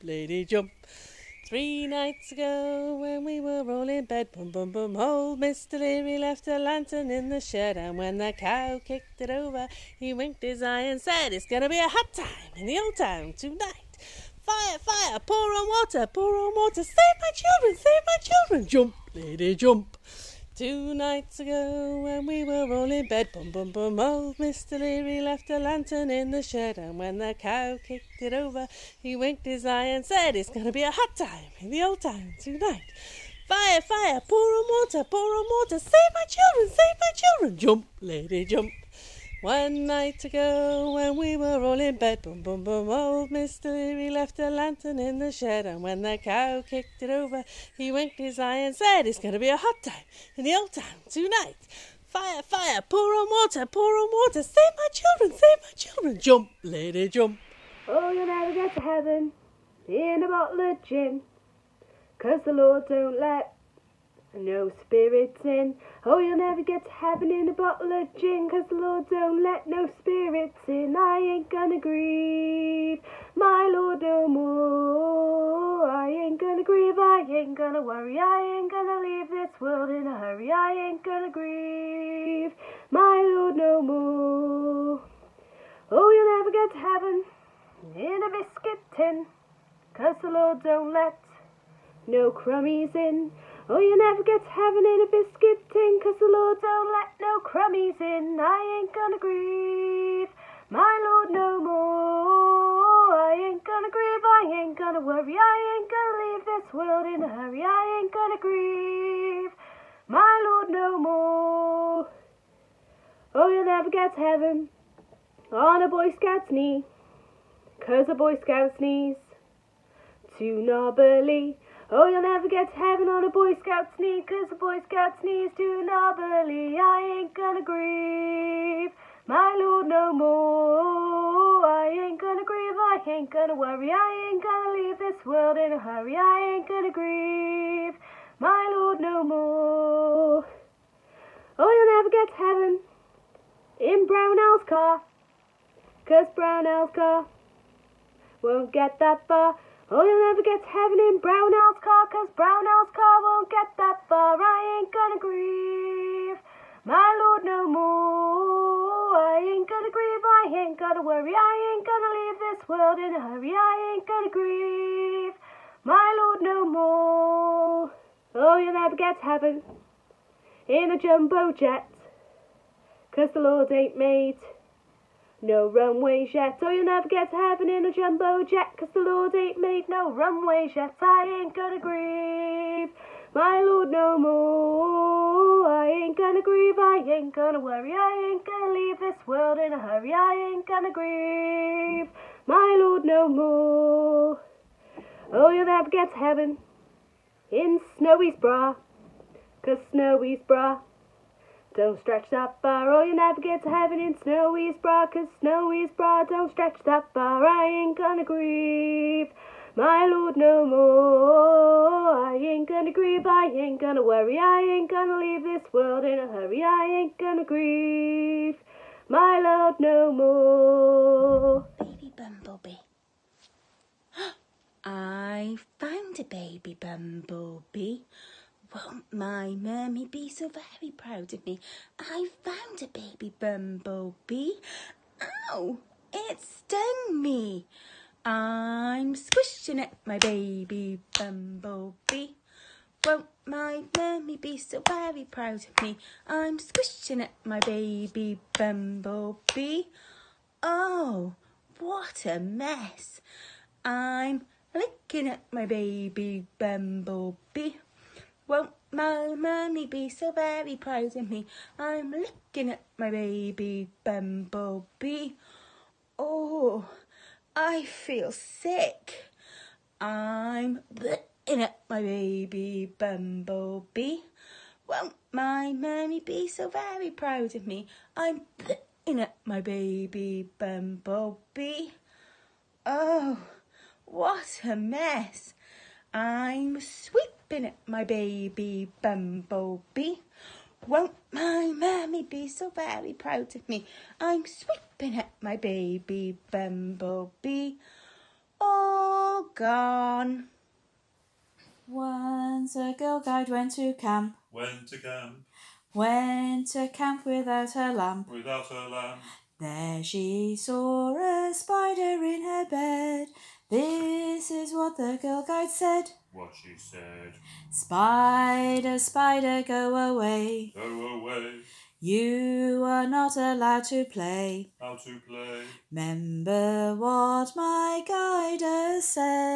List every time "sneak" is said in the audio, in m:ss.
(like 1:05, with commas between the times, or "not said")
2:03.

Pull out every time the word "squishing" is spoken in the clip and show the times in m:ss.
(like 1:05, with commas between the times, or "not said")
3:59, 4:06.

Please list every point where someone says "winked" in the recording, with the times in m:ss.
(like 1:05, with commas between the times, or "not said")
0:10, 0:29, 0:47.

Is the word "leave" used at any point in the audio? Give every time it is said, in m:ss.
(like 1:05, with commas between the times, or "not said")
1:18, 1:46, 2:14, 2:42, 3:08, 3:35.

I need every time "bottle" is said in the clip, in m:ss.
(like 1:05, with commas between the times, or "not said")
1:00, 1:07.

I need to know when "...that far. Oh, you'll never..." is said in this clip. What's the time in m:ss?
2:28.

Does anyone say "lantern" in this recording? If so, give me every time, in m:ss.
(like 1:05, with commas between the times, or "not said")
0:06, 0:25, 0:44.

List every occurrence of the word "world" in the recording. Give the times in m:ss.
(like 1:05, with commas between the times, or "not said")
1:19, 1:46, 2:15, 2:42, 3:09, 3:35.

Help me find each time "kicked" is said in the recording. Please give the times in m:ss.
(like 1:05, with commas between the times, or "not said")
0:08, 0:27, 0:46.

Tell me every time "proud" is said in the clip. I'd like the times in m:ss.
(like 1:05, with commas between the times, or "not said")
3:50, 4:05, 4:20, 4:37, 4:53.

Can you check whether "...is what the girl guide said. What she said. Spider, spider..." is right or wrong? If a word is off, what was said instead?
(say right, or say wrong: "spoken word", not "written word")
right.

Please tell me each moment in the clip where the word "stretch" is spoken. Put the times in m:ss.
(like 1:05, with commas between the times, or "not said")
3:22, 3:26.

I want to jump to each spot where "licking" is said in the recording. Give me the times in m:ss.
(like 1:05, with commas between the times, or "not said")
4:14.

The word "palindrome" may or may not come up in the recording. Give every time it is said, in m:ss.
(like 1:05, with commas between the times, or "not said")
not said.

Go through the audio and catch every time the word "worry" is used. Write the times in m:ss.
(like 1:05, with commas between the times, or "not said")
1:17, 1:45, 2:13, 2:41, 3:07, 3:34.